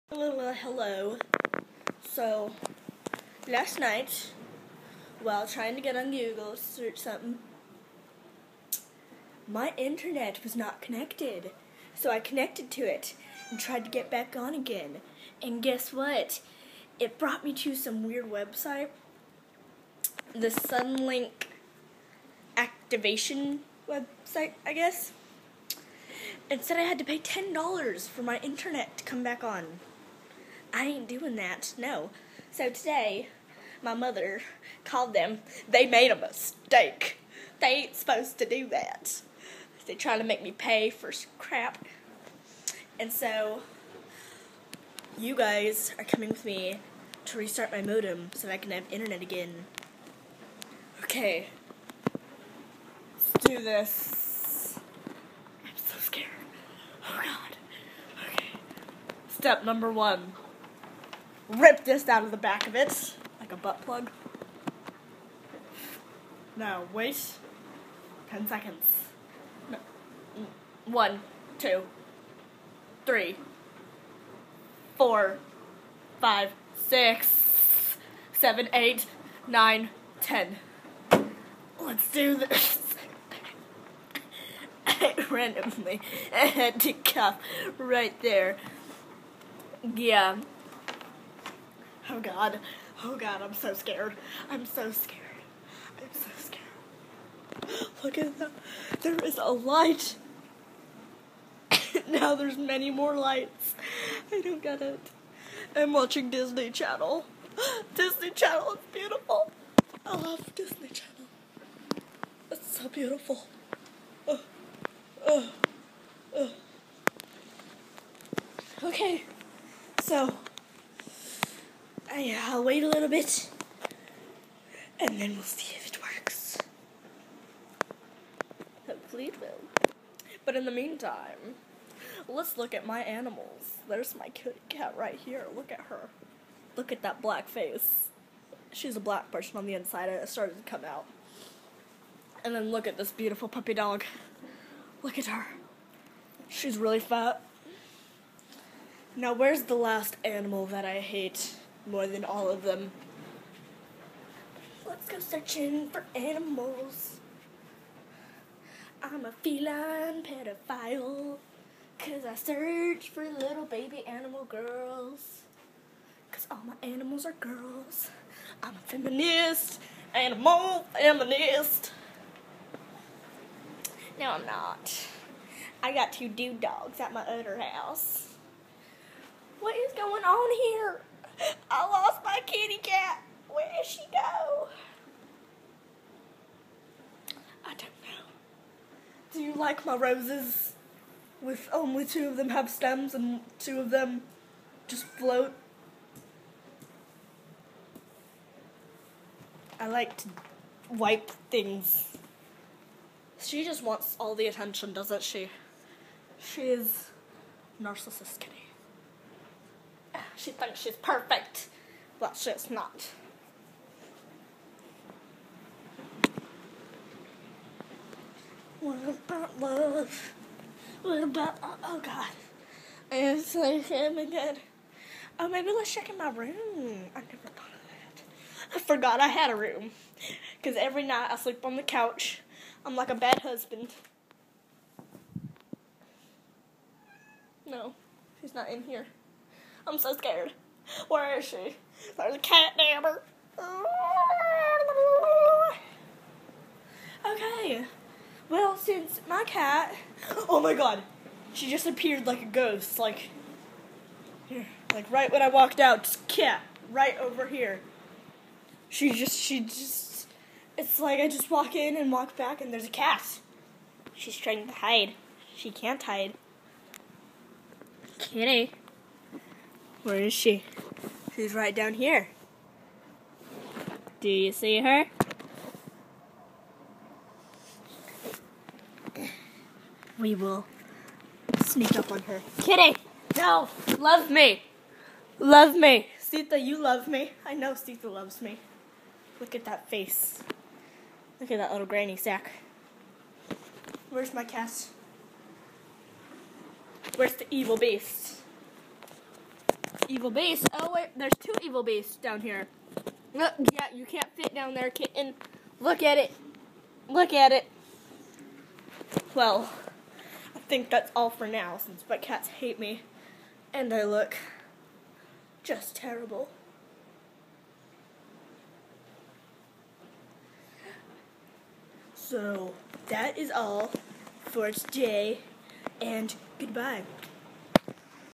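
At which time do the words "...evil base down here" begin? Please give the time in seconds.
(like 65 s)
301 s.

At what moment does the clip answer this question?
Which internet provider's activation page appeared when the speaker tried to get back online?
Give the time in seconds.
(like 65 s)
20 s.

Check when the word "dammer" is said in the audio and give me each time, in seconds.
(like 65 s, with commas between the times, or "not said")
242 s.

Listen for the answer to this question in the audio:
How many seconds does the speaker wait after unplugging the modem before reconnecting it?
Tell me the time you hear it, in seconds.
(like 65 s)
68 s.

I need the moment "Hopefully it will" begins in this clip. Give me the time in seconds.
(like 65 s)
128 s.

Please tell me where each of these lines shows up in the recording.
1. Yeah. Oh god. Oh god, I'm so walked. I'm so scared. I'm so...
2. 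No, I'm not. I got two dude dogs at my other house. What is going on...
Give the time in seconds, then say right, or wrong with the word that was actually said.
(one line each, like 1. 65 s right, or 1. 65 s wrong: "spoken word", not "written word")
1. 89 s wrong: "scared", not "walked"
2. 174 s right.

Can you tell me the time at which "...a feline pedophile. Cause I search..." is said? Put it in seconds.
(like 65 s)
159 s.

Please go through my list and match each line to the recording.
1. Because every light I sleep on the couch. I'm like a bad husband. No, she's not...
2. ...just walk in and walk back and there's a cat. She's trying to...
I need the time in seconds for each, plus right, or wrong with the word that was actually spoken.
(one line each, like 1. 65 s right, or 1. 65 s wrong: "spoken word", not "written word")
1. 230 s wrong: "night", not "light"
2. 261 s right.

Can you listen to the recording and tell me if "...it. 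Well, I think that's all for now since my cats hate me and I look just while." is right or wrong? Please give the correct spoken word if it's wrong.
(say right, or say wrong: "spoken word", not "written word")
wrong: "terrible", not "while".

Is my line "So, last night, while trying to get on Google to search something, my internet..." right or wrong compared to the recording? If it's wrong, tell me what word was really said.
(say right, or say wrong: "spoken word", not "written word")
right.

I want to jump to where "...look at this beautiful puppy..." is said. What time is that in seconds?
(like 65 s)
142 s.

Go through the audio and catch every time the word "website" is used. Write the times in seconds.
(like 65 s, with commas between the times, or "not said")
18 s, 23 s.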